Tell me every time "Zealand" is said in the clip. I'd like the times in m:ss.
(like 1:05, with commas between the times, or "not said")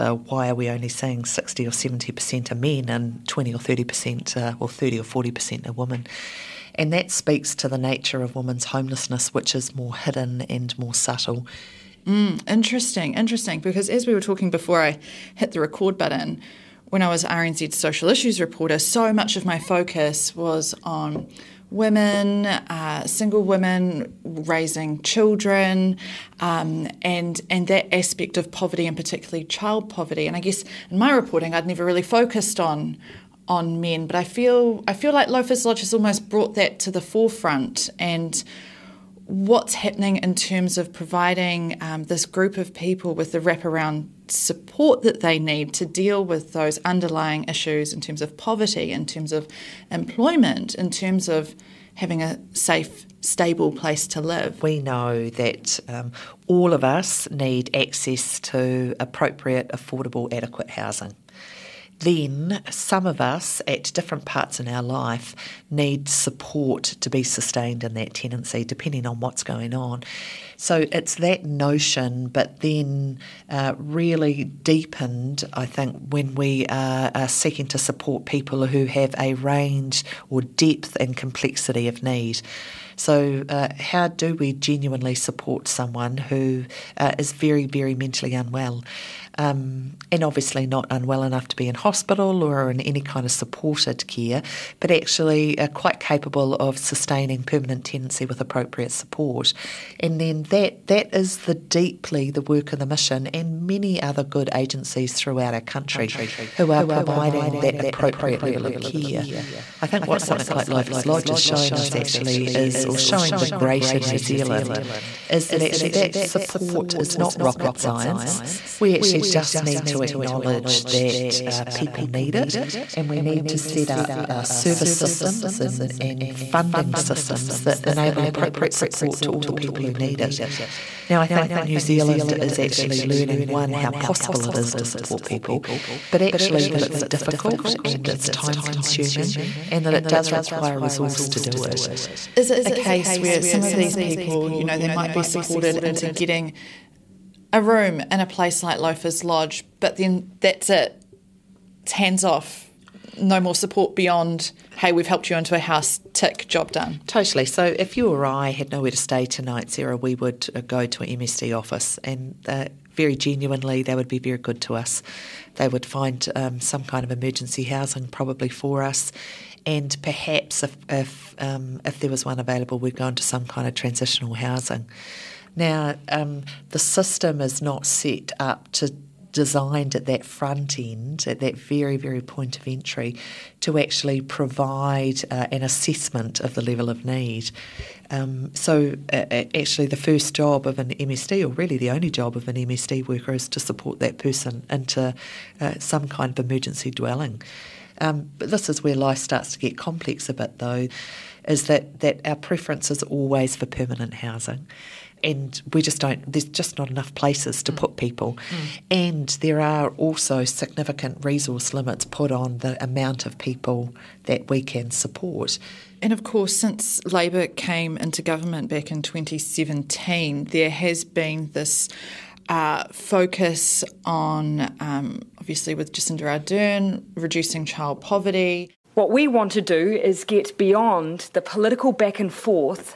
1:54, 2:11.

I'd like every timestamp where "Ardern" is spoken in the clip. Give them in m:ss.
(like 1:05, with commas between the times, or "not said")
3:46.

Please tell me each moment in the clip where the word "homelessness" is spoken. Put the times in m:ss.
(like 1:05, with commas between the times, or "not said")
0:08.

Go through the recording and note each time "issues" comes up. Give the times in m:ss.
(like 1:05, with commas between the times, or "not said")
0:18, 0:47.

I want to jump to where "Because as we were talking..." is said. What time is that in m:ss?
0:13.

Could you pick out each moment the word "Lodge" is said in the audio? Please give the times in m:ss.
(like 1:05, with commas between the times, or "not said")
0:35, 1:51, 2:29.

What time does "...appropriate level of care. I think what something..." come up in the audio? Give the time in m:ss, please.
1:47.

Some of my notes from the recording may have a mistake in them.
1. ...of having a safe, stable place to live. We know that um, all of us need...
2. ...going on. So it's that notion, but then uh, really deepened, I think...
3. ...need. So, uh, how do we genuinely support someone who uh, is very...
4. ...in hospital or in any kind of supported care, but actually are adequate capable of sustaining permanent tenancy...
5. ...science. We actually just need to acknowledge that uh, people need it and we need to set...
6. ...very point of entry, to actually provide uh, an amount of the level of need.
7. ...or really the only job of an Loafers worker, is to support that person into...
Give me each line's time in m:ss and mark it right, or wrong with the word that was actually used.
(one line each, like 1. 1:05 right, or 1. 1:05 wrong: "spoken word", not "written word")
1. 0:51 right
2. 1:09 right
3. 1:22 right
4. 1:31 wrong: "quite", not "adequate"
5. 1:57 right
6. 3:01 wrong: "assessment", not "amount"
7. 3:11 wrong: "MSD", not "Loafers".